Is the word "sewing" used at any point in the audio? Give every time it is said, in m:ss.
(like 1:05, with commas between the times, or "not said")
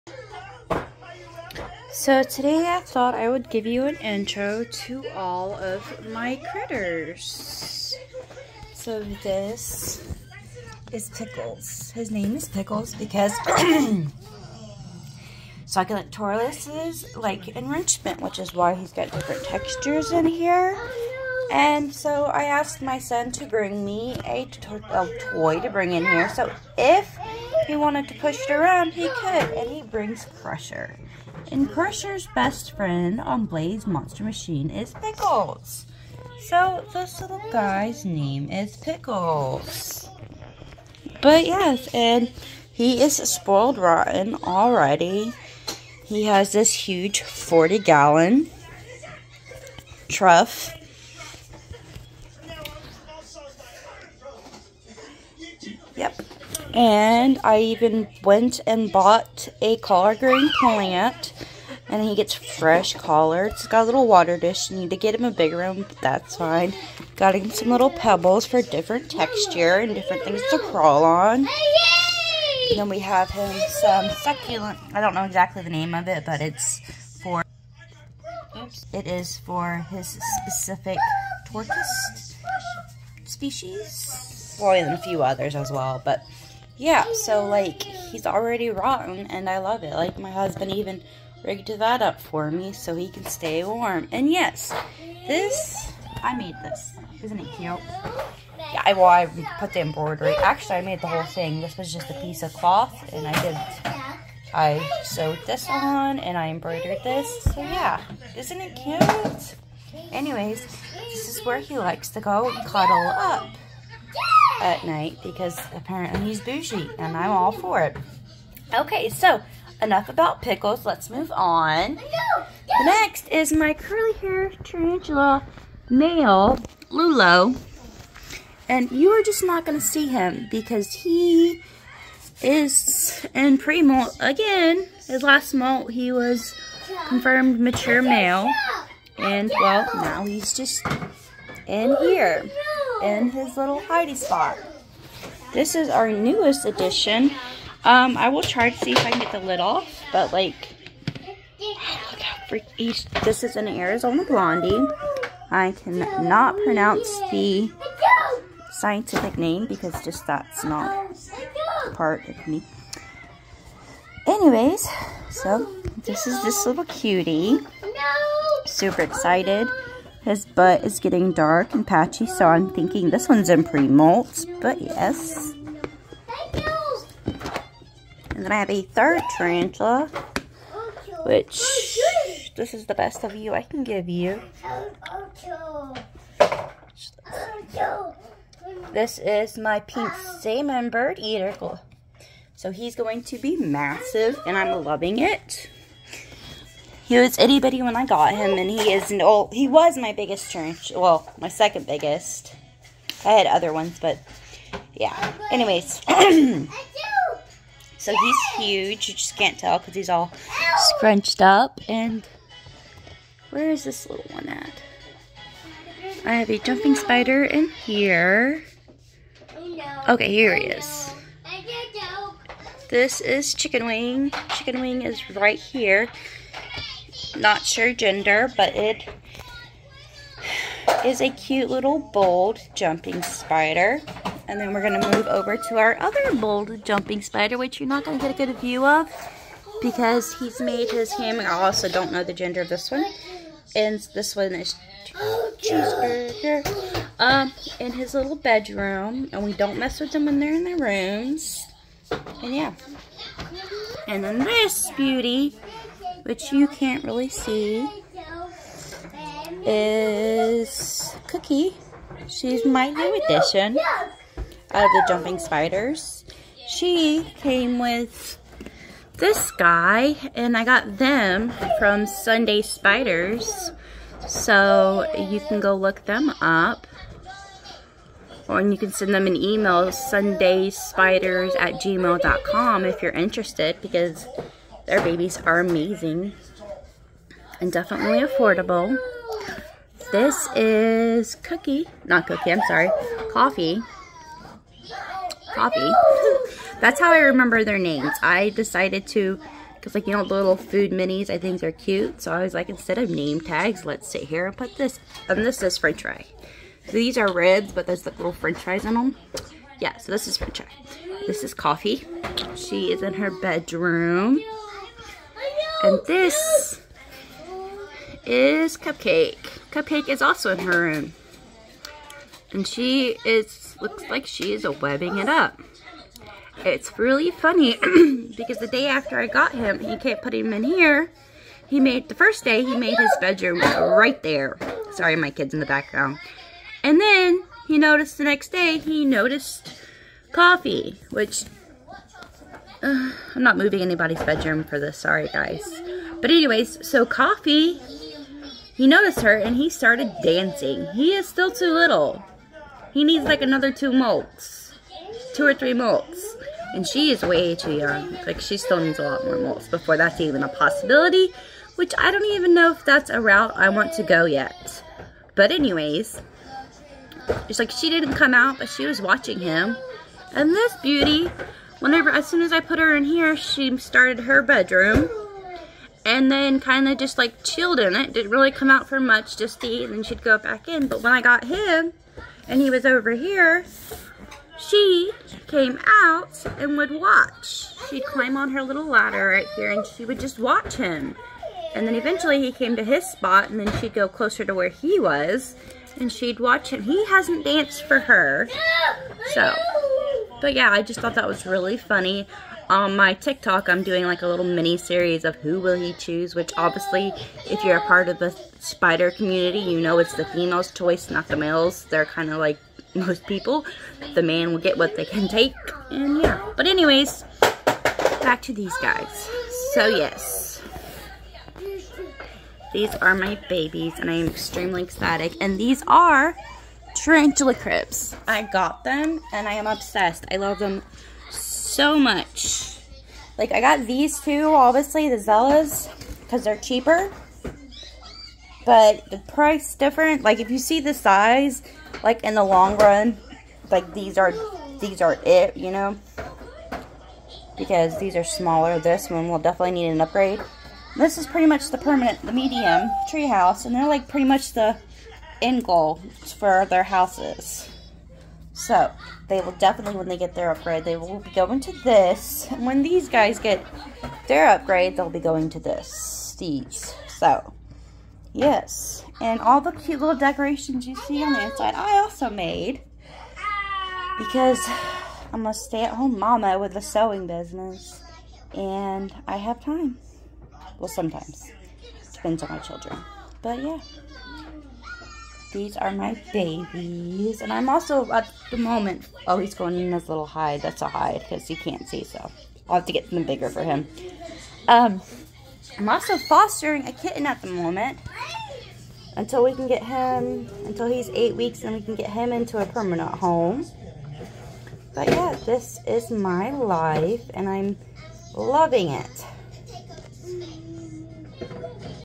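7:56.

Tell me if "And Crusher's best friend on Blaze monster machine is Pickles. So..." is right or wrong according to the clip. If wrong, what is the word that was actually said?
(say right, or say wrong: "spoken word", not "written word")
right.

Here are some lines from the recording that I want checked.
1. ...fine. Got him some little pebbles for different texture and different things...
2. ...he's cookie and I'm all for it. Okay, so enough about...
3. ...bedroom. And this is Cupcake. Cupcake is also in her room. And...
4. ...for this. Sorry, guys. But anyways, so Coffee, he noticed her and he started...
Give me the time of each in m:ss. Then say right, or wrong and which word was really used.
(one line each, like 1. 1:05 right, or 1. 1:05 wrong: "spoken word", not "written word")
1. 1:06 right
2. 1:56 wrong: "bougie", not "cookie"
3. 5:13 right
4. 5:44 right.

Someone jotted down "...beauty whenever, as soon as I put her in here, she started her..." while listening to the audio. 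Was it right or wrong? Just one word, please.
right.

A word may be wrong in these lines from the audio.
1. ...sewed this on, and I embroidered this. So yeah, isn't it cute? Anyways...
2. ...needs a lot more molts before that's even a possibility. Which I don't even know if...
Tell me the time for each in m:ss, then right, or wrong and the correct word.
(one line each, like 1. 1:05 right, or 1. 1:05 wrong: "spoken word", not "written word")
1. 1:45 right
2. 5:58 right.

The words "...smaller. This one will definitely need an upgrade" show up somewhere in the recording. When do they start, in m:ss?
7:28.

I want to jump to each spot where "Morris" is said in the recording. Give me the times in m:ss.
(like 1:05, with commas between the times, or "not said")
not said.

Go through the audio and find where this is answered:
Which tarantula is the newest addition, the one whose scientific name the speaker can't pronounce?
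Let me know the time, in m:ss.
2:33.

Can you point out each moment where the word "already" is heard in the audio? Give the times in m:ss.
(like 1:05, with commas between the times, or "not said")
0:44, 1:28.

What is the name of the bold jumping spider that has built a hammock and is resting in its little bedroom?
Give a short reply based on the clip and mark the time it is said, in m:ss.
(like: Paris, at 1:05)
Cheeseburger, at 4:05.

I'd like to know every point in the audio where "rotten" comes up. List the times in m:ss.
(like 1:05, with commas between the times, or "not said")
0:43, 1:28.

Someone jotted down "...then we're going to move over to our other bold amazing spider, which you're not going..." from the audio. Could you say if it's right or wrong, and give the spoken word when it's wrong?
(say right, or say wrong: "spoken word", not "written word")
wrong: "jumping", not "amazing".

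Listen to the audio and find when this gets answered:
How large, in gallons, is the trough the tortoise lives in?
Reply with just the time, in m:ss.
0:47.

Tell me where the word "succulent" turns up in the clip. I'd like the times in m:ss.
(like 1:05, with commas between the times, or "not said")
0:15, 1:14.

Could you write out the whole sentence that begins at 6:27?
She'd climb on her little ladder right here and she would just watch him.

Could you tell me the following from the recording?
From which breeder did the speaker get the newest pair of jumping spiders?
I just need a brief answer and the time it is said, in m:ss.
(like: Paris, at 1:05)
Sunday Spiders, at 4:32.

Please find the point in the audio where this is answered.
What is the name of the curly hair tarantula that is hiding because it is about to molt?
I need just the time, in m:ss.
2:06.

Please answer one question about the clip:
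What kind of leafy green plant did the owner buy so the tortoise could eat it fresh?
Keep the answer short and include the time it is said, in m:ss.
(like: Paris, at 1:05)
Collard green, at 0:59.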